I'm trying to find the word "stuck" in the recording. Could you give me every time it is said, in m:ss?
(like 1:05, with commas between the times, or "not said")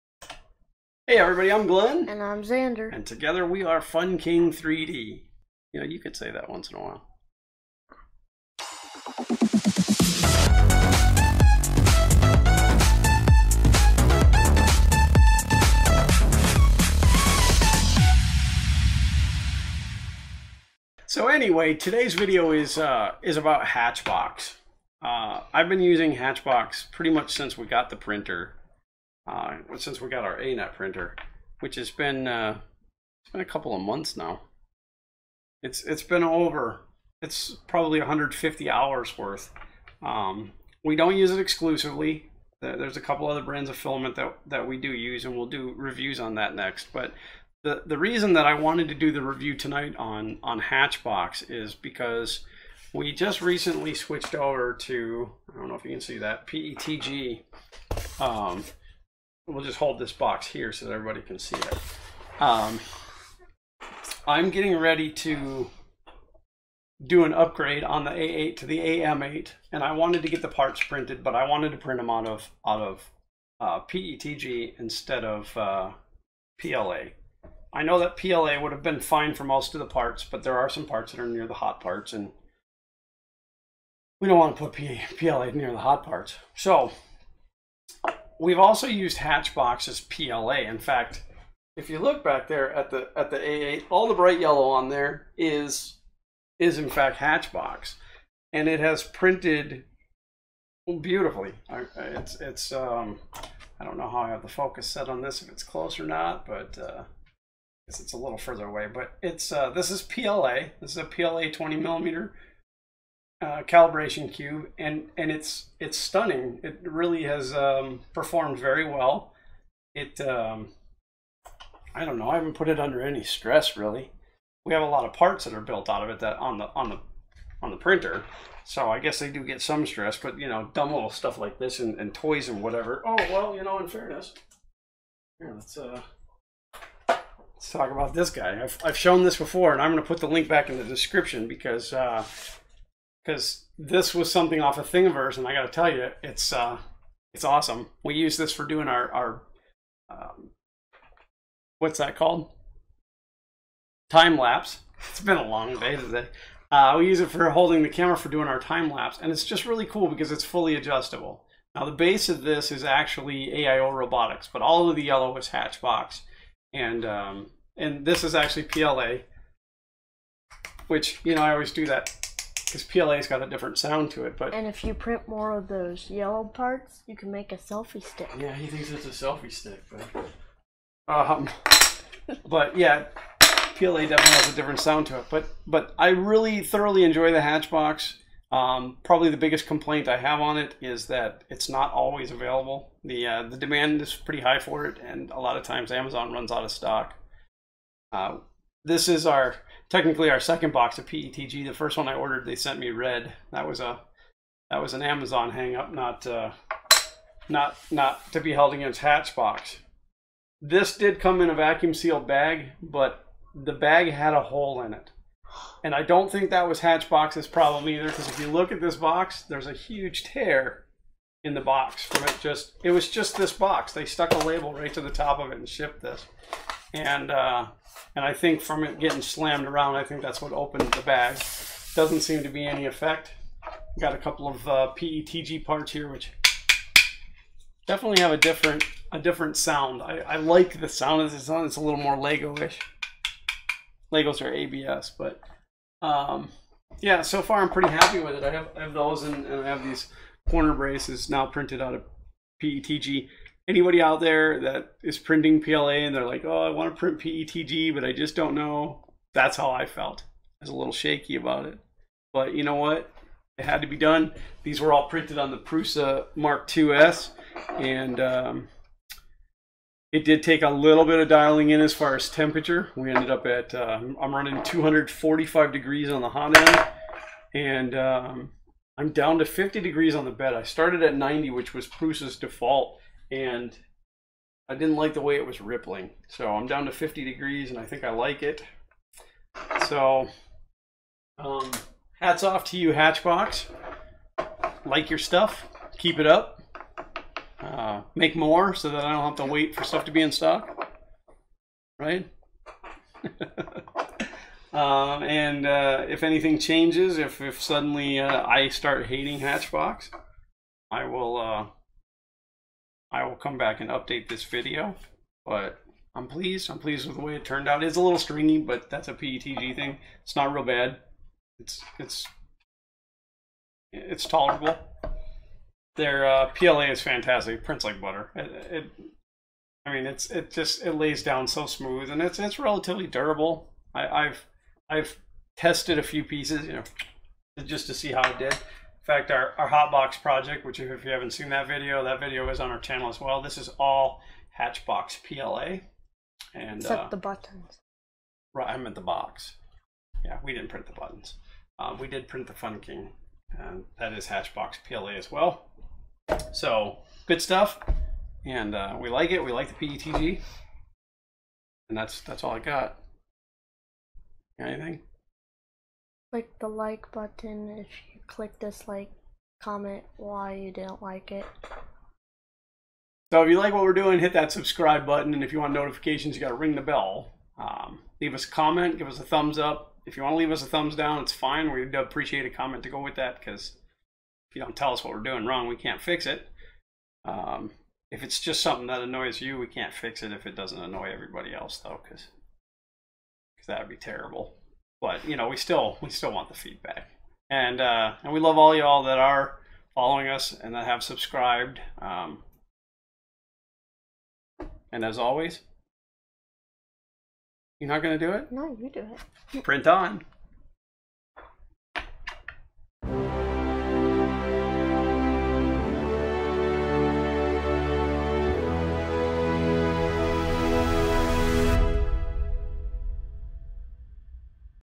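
3:44.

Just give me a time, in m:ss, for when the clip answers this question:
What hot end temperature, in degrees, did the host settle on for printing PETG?
4:34.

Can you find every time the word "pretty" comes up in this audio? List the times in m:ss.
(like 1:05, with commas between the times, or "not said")
0:26, 3:14, 4:07.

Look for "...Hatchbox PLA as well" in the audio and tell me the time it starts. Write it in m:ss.
5:54.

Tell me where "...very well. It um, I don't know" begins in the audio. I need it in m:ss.
1:58.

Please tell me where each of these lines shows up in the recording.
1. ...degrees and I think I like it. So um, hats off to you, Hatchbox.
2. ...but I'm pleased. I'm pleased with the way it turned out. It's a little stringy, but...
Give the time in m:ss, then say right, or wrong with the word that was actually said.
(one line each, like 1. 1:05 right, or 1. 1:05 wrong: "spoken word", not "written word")
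1. 4:47 right
2. 5:15 right.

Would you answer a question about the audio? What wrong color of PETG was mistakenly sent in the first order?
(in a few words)
red.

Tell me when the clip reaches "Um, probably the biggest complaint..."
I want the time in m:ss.
3:08.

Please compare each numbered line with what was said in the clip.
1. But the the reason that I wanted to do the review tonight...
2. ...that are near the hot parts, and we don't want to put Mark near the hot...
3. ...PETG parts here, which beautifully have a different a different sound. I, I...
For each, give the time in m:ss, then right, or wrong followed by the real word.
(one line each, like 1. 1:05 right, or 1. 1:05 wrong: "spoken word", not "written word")
1. 0:46 right
2. 1:21 wrong: "PLA", not "Mark"
3. 3:54 wrong: "definitely", not "beautifully".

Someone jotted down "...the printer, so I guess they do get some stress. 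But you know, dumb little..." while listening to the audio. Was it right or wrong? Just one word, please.
right.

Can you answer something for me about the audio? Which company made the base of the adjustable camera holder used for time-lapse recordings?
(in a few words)
AIO Robotics.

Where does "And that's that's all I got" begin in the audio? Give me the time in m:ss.
6:01.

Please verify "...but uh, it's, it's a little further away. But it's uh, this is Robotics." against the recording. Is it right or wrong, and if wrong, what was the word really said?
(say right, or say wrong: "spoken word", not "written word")
wrong: "PLA", not "Robotics".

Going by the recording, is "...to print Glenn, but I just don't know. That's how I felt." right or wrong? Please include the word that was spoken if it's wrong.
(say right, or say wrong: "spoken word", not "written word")
wrong: "PETG", not "Glenn".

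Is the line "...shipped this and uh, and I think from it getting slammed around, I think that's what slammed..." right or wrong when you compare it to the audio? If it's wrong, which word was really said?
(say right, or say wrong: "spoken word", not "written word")
wrong: "opened", not "slammed".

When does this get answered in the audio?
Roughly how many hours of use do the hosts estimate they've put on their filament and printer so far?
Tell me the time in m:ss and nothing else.
0:37.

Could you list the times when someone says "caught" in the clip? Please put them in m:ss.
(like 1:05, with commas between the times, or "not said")
not said.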